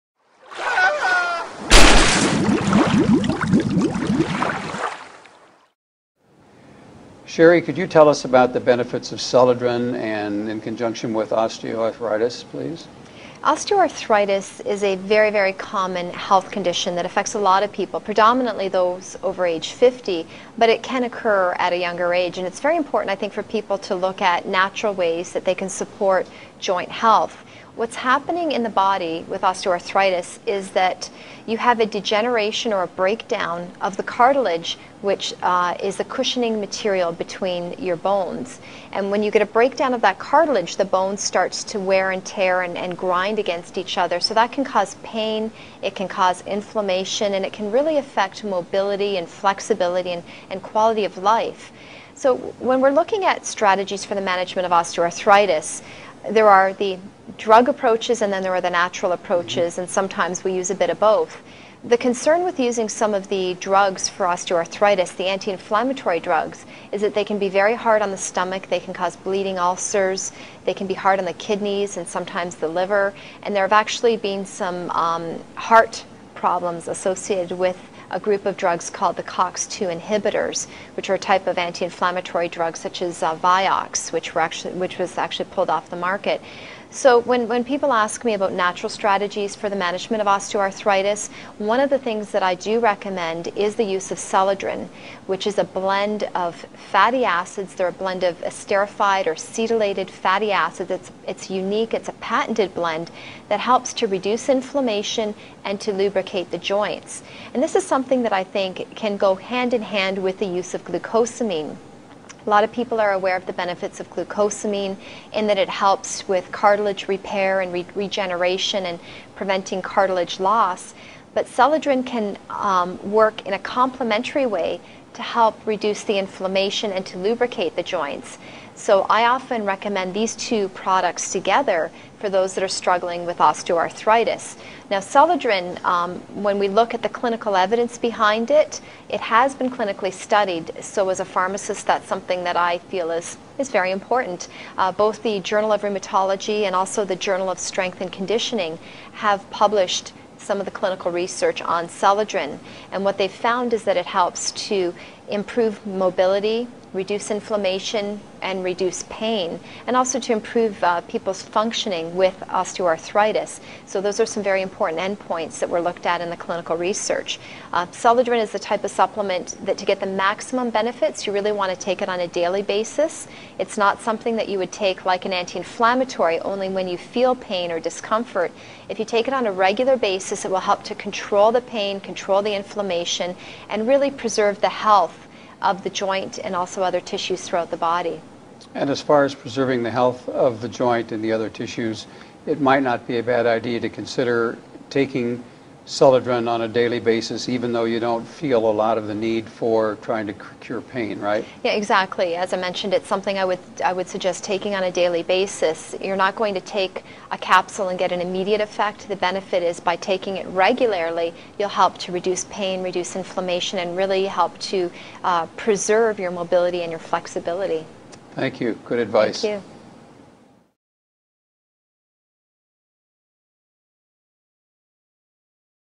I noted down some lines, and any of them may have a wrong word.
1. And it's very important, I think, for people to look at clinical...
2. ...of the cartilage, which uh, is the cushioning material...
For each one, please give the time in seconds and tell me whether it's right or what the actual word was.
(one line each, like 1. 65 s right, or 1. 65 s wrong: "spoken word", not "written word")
1. 22 s wrong: "natural", not "clinical"
2. 33 s right.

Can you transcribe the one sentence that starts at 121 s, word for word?
But Celadrin can um, work in a complementary way to help reduce the inflammation and to lubricate the joints.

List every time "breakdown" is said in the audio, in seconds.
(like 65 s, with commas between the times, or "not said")
32 s, 39 s.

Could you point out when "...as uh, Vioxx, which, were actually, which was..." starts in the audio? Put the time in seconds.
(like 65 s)
83 s.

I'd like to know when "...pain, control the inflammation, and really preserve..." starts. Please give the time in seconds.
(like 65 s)
181 s.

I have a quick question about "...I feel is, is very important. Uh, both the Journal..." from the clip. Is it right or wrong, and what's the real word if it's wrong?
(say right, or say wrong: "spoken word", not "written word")
right.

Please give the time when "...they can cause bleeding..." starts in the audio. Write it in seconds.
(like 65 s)
68 s.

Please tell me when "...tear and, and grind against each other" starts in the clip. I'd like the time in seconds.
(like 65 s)
42 s.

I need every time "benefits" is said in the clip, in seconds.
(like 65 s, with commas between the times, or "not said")
8 s, 113 s, 170 s, 209 s.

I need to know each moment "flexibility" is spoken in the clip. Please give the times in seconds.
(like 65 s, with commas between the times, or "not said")
49 s, 216 s.